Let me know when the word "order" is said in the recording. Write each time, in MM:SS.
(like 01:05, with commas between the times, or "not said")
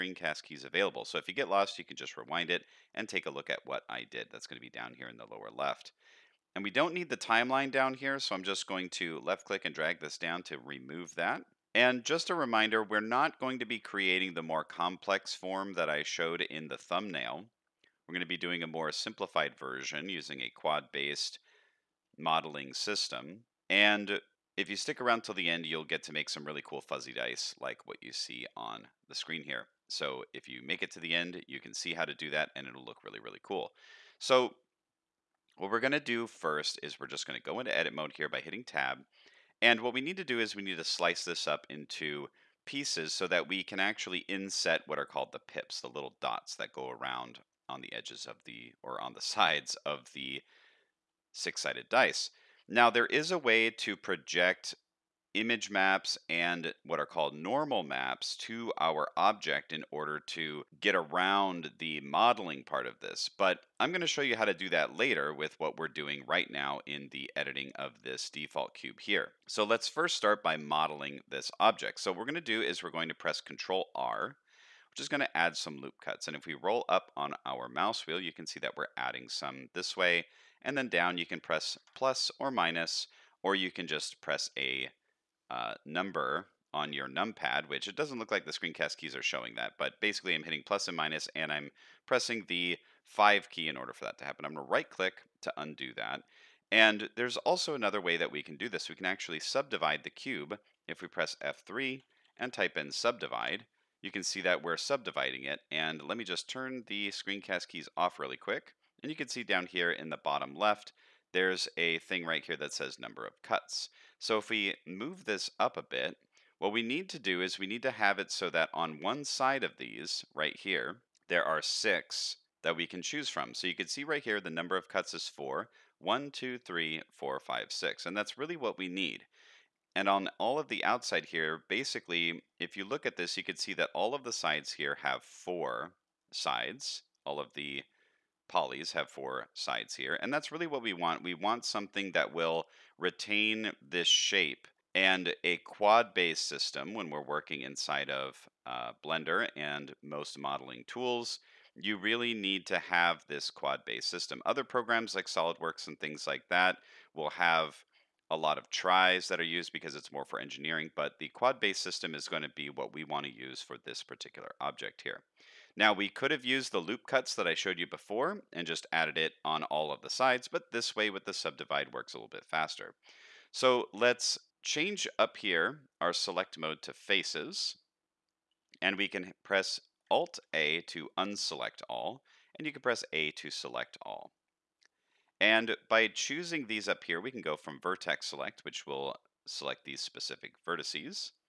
00:59, 01:33.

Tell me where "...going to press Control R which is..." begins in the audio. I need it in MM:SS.
01:12.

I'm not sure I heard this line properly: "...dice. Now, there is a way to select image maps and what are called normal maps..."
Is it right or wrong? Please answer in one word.
wrong.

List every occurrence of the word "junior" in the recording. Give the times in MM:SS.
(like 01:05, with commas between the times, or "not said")
not said.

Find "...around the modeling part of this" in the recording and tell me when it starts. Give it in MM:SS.
01:00.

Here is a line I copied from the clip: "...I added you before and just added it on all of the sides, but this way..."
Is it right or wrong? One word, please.
wrong.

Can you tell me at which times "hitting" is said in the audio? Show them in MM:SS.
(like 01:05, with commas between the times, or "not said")
00:38, 01:30.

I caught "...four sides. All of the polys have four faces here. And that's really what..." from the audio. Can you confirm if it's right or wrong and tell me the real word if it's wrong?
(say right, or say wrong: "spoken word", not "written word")
wrong: "sides", not "faces".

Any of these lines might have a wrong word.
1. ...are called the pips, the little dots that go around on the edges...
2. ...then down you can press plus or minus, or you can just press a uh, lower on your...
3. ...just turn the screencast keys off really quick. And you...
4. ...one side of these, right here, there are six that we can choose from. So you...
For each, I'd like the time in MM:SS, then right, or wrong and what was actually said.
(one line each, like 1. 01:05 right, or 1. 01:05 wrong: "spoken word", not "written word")
1. 00:44 right
2. 01:20 wrong: "number", not "lower"
3. 01:46 right
4. 01:59 right.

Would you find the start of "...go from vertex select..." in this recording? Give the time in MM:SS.
03:07.